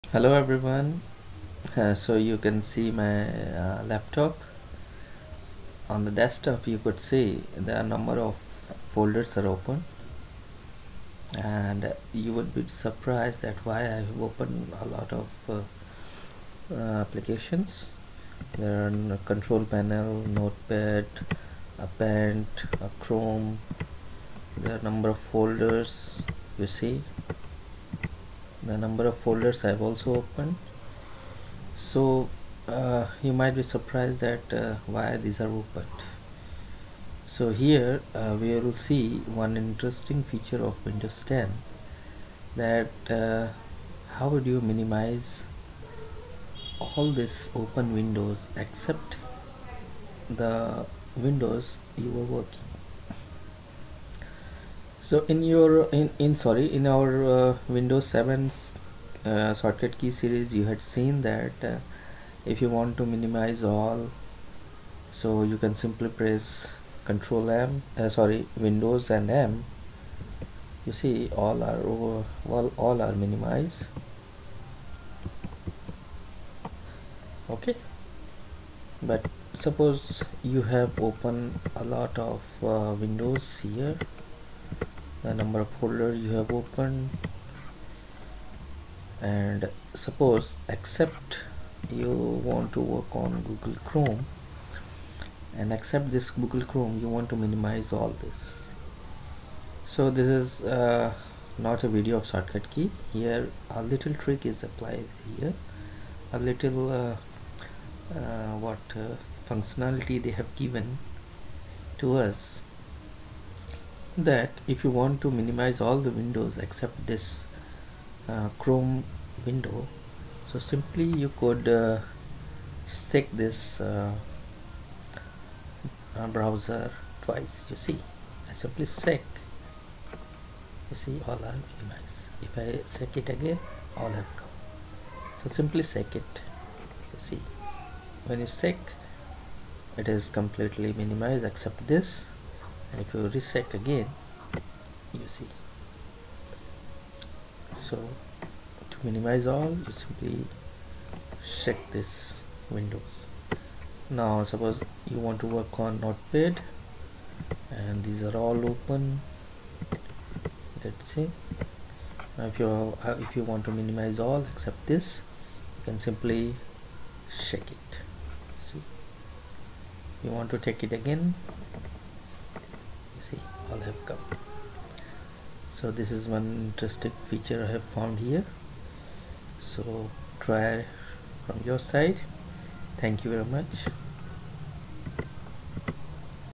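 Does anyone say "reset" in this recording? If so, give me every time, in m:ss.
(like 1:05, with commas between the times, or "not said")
2:23.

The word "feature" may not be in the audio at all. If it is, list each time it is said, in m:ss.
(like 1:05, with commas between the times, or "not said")
0:40, 2:57.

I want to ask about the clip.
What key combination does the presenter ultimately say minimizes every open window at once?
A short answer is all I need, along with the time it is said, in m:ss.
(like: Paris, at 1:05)
Windows and M, at 1:08.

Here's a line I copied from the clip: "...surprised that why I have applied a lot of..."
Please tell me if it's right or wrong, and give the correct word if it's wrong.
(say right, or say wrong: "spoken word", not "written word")
wrong: "opened", not "applied".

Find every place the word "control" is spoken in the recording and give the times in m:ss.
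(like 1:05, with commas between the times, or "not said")
0:19, 1:07.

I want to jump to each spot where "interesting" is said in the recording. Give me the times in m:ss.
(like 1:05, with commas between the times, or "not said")
0:39, 2:56.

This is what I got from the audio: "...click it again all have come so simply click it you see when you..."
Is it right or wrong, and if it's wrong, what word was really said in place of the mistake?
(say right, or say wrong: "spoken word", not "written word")
right.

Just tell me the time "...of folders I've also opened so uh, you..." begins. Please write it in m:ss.
0:29.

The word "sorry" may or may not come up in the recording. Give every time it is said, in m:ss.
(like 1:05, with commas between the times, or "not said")
0:56, 1:08.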